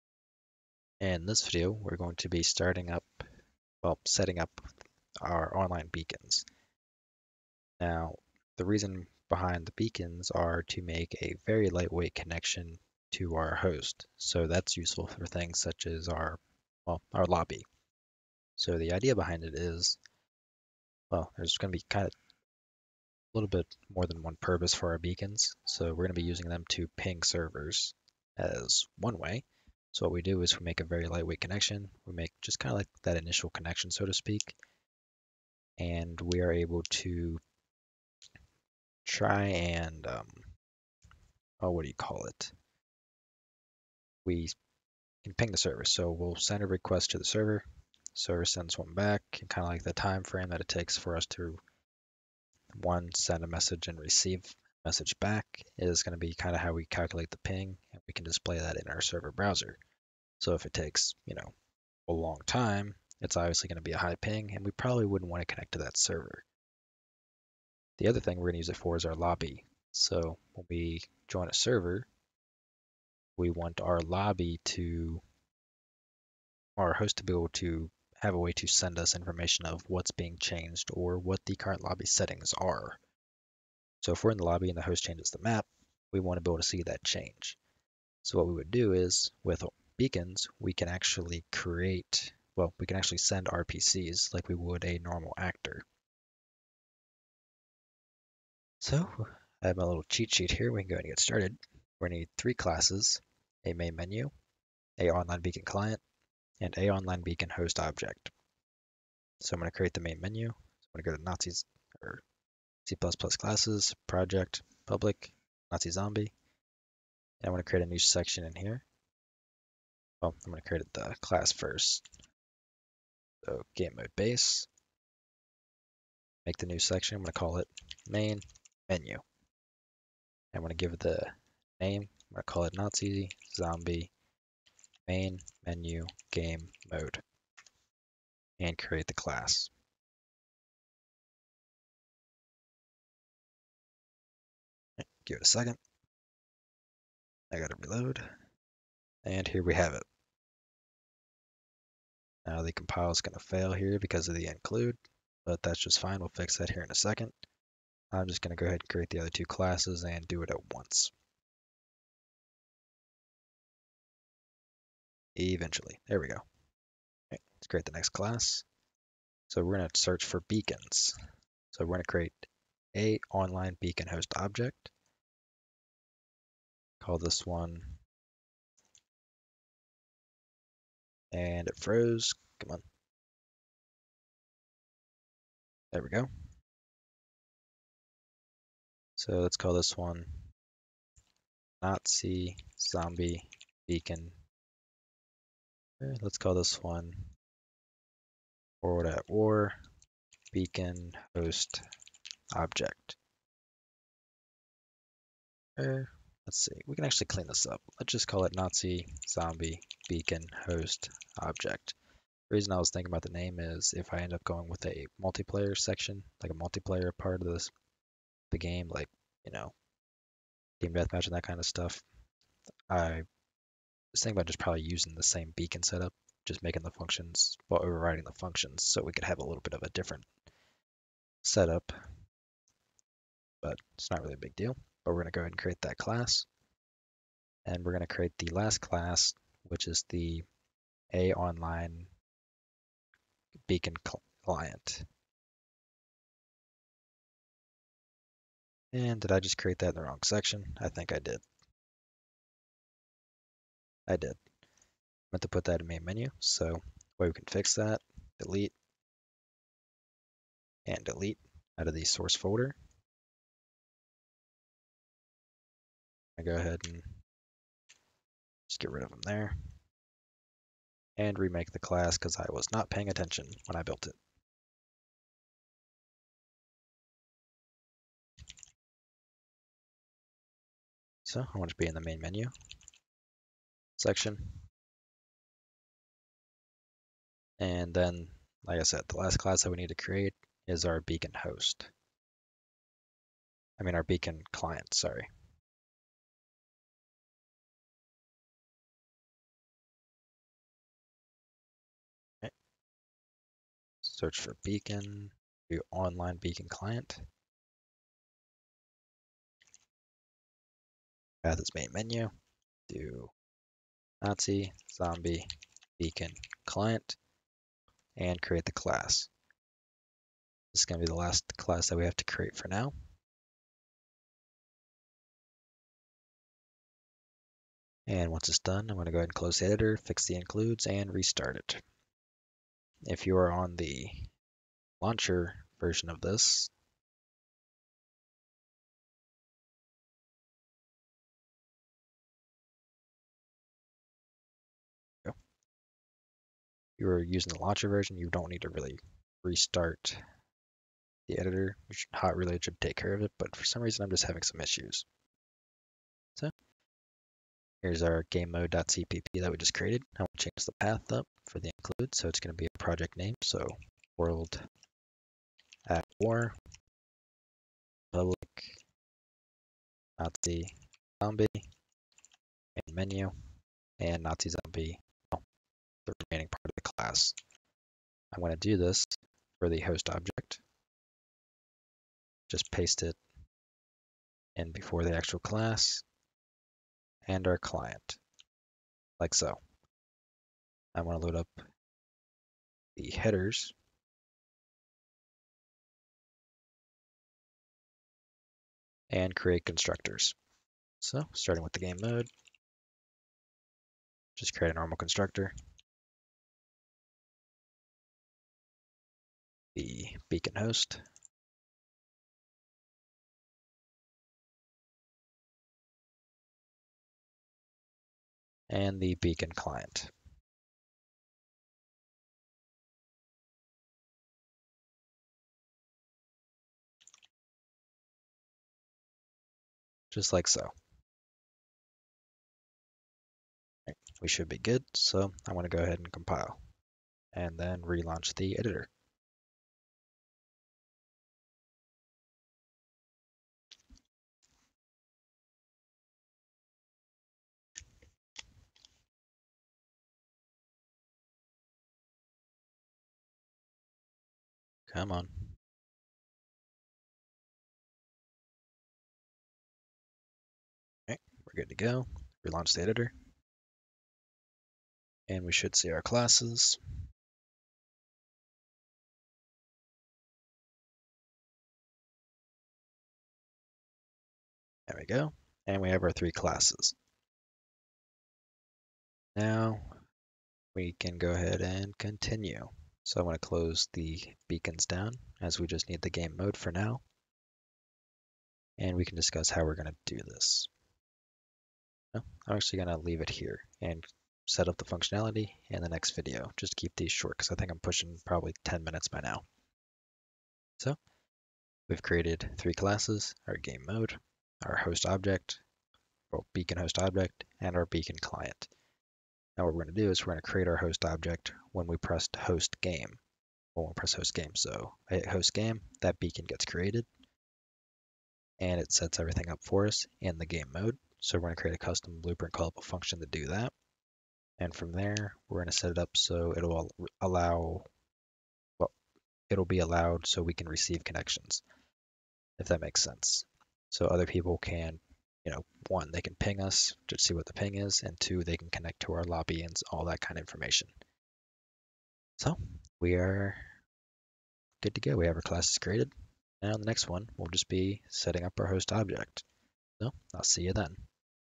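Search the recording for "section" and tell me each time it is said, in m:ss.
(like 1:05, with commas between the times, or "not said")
1:57, 2:06, 3:35, 4:10, 4:43.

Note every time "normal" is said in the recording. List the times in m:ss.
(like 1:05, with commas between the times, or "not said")
1:34, 6:44.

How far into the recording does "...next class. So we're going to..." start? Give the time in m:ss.
2:47.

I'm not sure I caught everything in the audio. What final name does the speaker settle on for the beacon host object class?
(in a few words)
Nazi zombie beacon host object.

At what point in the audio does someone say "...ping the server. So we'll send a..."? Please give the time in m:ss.
0:45.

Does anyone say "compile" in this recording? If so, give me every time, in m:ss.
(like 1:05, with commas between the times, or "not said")
2:32, 7:16.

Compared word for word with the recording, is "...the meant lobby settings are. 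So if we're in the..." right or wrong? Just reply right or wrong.
wrong.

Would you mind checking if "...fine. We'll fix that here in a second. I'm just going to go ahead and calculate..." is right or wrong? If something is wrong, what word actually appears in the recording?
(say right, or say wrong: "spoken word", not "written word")
wrong: "create", not "calculate".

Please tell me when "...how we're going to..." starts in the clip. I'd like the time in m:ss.
8:09.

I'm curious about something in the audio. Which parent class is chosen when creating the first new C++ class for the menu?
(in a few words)
Game mode base.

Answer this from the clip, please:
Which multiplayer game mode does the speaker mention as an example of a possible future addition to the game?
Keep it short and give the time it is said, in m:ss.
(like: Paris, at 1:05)
Team deathmatch, at 3:40.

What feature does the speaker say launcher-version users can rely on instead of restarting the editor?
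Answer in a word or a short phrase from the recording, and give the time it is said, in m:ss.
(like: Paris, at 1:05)
Hot Reload, at 5:52.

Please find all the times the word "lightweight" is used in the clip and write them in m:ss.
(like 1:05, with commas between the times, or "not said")
0:11, 0:31.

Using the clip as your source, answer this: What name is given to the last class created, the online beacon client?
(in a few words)
Nazi zombie beacon client.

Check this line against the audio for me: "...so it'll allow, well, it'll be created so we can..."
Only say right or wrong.
wrong.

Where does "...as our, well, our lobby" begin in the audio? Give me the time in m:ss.
0:15.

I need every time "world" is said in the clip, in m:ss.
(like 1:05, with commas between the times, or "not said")
3:18, 6:04.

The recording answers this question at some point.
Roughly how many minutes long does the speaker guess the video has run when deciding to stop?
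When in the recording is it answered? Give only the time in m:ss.
8:18.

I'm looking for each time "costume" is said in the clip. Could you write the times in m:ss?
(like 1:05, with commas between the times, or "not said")
not said.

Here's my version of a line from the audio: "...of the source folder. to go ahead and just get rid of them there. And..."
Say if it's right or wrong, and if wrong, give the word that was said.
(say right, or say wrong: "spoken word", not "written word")
right.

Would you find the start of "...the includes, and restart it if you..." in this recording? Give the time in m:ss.
5:30.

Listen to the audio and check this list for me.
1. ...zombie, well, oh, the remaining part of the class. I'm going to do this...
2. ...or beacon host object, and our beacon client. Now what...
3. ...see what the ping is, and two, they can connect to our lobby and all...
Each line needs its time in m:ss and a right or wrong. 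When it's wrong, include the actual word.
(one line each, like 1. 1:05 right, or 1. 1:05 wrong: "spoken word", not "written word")
1. 6:14 right
2. 8:26 right
3. 8:57 right.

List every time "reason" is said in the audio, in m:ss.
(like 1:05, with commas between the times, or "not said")
0:08, 3:32, 5:53.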